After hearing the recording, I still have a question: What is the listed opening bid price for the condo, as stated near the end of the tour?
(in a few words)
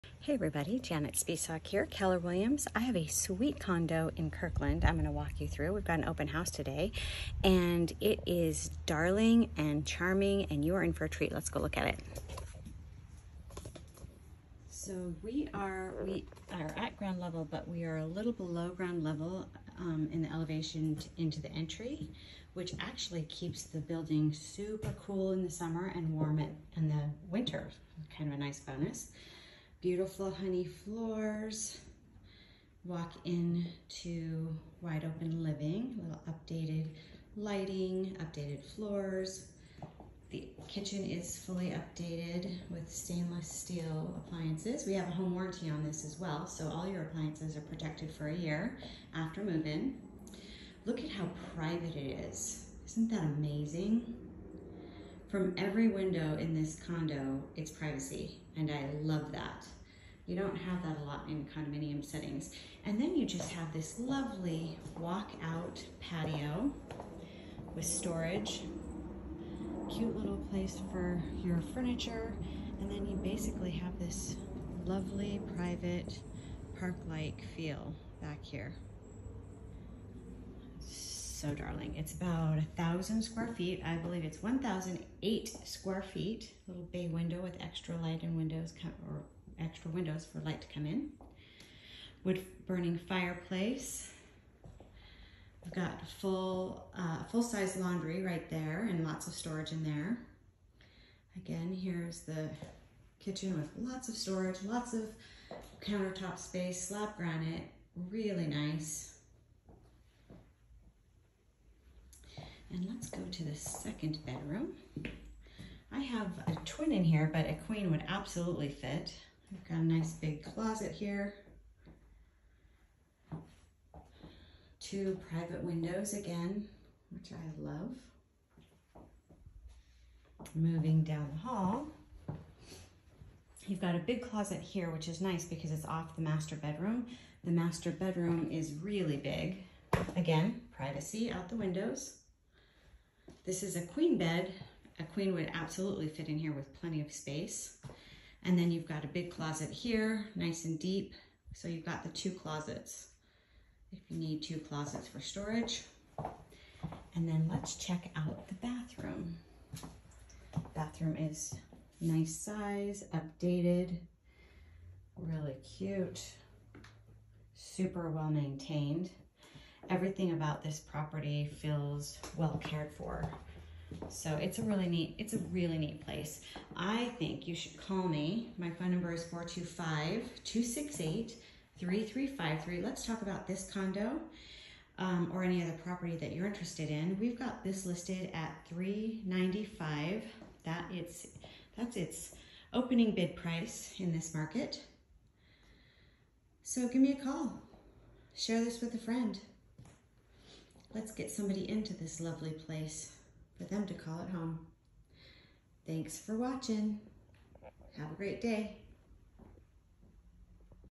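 395.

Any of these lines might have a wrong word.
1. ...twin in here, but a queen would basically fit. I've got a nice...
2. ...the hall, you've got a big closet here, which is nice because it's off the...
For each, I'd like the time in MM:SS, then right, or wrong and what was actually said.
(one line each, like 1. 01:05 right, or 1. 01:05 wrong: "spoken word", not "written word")
1. 01:56 wrong: "absolutely", not "basically"
2. 02:11 right.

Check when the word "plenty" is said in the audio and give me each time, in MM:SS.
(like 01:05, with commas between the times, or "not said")
02:26.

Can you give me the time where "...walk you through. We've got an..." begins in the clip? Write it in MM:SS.
00:05.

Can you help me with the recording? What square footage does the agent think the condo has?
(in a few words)
1,008 square feet.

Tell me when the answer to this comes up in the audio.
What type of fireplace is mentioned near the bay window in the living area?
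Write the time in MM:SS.
01:32.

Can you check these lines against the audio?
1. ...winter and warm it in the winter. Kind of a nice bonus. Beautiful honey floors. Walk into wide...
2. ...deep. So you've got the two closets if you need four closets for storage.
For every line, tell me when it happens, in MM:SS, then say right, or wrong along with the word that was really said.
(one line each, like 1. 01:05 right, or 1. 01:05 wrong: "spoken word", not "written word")
1. 00:25 wrong: "summer", not "winter"
2. 02:30 wrong: "two", not "four".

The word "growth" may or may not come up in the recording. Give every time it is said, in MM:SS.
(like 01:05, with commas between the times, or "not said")
not said.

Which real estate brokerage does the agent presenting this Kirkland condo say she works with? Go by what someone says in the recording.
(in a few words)
Keller Williams.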